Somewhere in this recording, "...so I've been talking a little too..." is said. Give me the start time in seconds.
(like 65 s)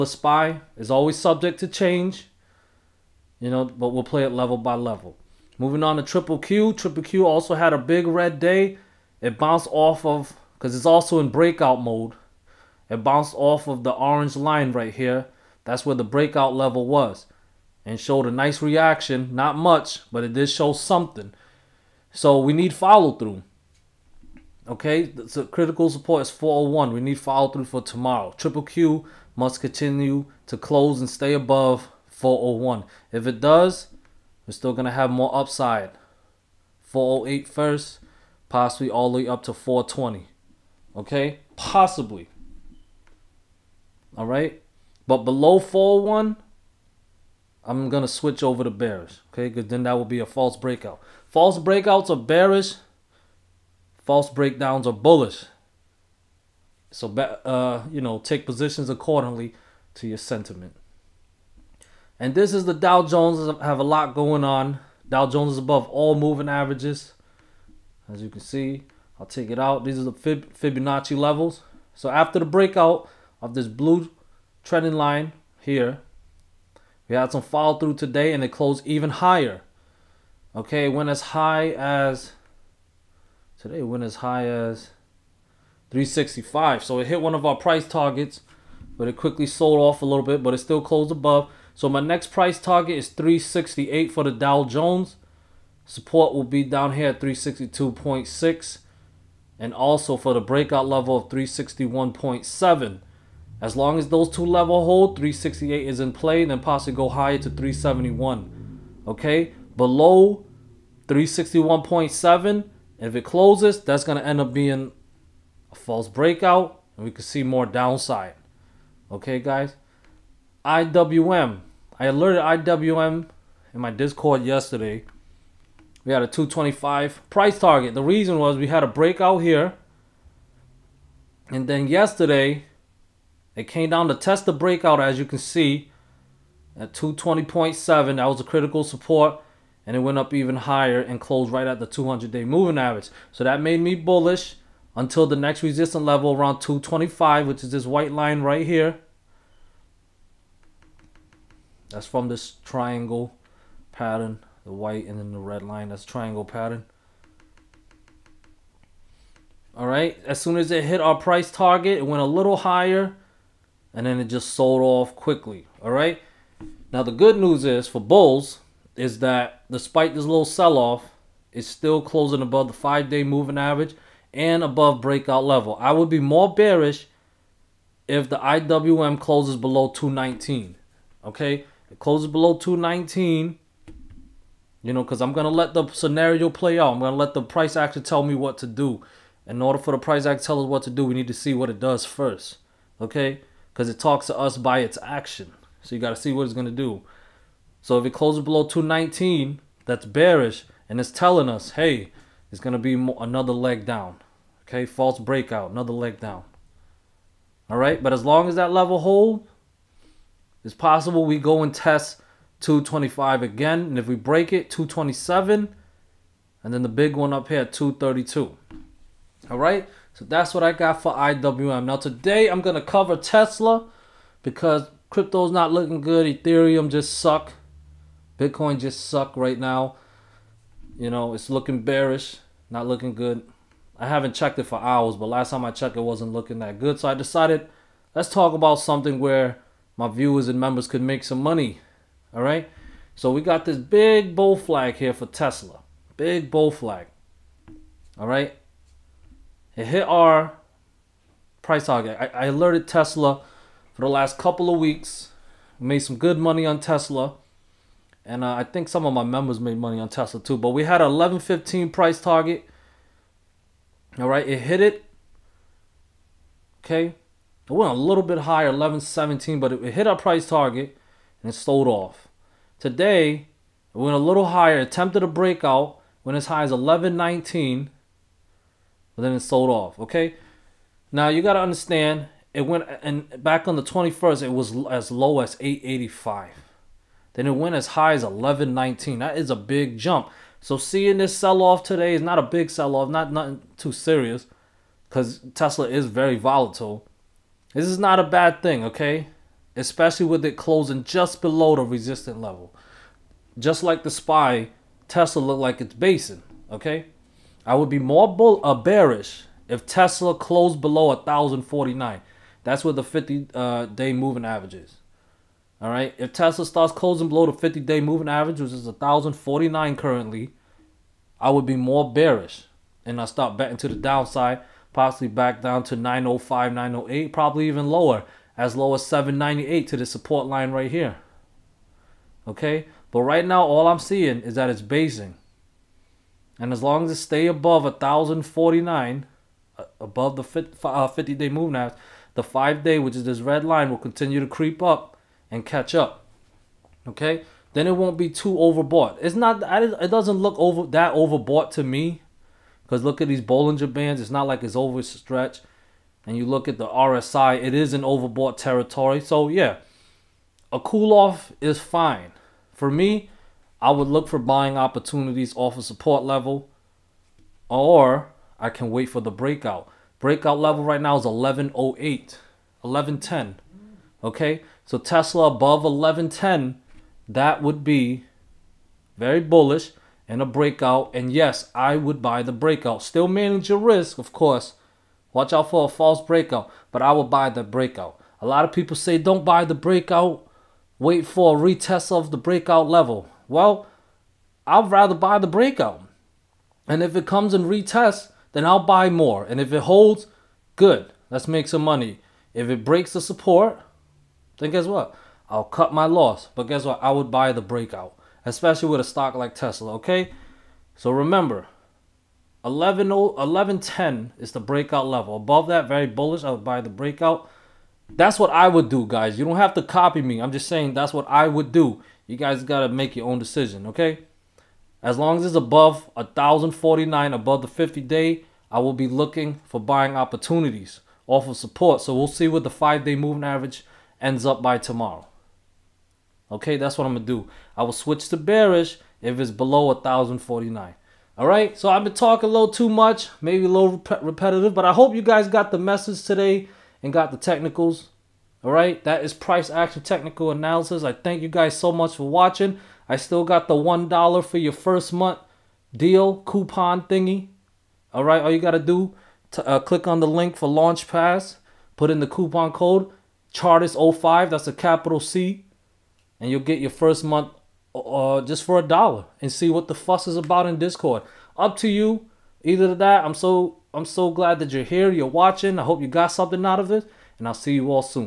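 441 s.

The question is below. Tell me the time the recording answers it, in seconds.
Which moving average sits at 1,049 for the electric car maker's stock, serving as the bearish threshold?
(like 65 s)
313 s.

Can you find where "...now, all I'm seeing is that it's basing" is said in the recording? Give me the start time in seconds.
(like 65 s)
333 s.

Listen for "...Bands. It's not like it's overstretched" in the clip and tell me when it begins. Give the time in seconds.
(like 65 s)
353 s.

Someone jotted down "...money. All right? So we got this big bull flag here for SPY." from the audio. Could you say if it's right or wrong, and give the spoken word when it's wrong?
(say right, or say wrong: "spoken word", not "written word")
wrong: "Tesla", not "SPY".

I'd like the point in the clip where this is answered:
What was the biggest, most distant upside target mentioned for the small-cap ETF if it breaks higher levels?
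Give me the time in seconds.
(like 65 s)
217 s.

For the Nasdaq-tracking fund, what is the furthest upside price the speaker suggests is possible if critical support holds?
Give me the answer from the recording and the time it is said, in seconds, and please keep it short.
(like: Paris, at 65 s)
420, at 39 s.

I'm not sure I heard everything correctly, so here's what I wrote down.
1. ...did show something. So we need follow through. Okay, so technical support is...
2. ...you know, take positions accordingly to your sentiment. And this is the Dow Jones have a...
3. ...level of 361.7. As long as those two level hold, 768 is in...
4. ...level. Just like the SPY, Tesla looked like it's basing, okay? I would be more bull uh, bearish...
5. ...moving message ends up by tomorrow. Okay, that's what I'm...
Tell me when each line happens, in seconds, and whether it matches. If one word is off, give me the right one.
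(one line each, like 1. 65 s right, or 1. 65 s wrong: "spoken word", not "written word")
1. 20 s wrong: "critical", not "technical"
2. 57 s right
3. 100 s wrong: "368", not "768"
4. 302 s right
5. 433 s wrong: "average", not "message".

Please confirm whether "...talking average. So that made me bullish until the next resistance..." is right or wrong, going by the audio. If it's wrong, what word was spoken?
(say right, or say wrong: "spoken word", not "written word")
wrong: "moving", not "talking".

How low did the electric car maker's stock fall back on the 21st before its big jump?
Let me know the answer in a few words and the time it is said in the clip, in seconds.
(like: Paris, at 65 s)
885, at 285 s.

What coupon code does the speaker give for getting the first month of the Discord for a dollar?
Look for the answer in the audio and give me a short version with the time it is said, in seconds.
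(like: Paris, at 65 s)
Chartist05, at 463 s.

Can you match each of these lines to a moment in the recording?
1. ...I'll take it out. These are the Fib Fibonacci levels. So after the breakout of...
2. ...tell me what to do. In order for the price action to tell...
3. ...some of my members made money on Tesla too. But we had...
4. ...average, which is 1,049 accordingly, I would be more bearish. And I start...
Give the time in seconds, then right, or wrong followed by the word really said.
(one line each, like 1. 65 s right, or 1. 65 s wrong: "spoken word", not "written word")
1. 69 s right
2. 188 s right
3. 258 s right
4. 318 s wrong: "currently", not "accordingly".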